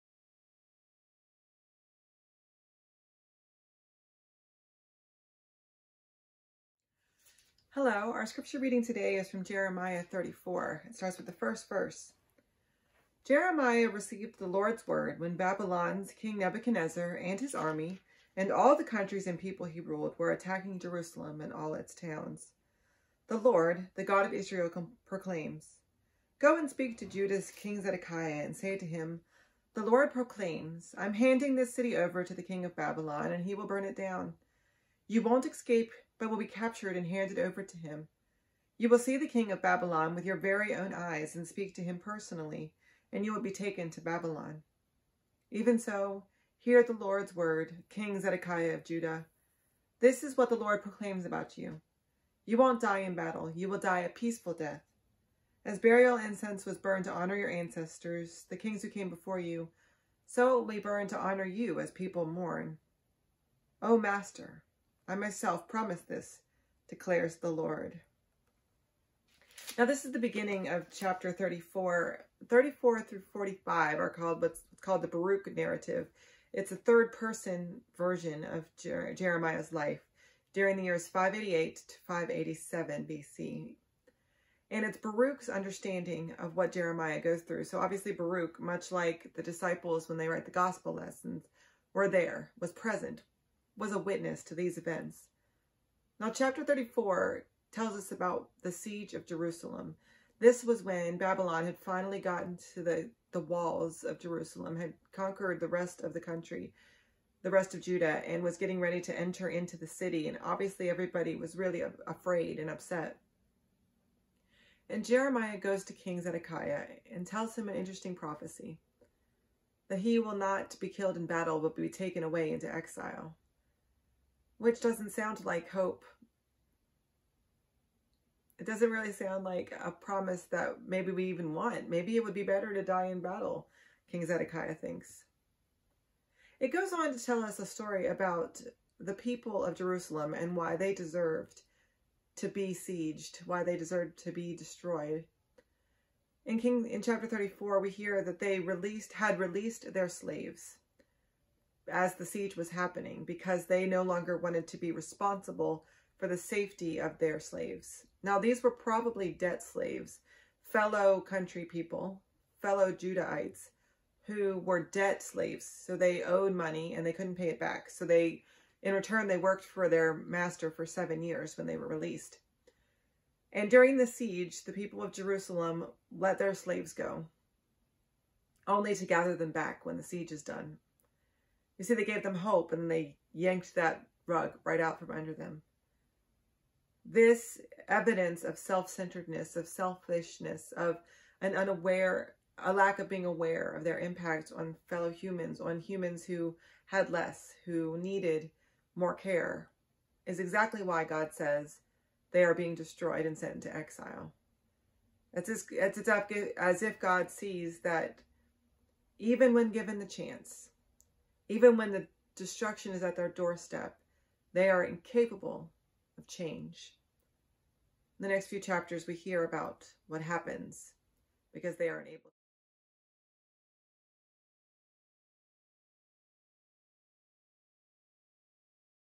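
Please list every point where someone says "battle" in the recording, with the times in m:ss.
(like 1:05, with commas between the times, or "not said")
0:53, 2:01, 2:13.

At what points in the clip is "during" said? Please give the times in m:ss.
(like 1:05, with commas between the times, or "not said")
1:20, 2:53.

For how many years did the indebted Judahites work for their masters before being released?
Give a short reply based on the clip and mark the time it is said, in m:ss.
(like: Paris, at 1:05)
7, at 2:50.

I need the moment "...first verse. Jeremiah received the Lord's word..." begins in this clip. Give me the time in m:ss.
0:11.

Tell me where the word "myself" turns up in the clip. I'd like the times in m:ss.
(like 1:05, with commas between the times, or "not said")
1:05.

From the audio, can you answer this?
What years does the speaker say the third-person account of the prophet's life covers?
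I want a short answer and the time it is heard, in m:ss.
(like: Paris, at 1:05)
588 to 587 BC, at 1:21.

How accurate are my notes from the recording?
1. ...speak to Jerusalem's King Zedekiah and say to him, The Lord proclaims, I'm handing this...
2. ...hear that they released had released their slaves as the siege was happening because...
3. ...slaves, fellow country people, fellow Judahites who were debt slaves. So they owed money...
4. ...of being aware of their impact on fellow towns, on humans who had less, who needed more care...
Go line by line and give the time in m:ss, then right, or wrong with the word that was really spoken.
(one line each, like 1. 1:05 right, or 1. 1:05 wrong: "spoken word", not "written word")
1. 0:26 wrong: "Judah", not "Jerusalem"
2. 2:27 right
3. 2:39 right
4. 3:12 wrong: "humans", not "towns".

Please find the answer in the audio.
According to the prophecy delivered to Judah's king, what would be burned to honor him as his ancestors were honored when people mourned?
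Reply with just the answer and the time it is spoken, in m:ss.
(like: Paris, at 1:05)
Burial incense, at 0:55.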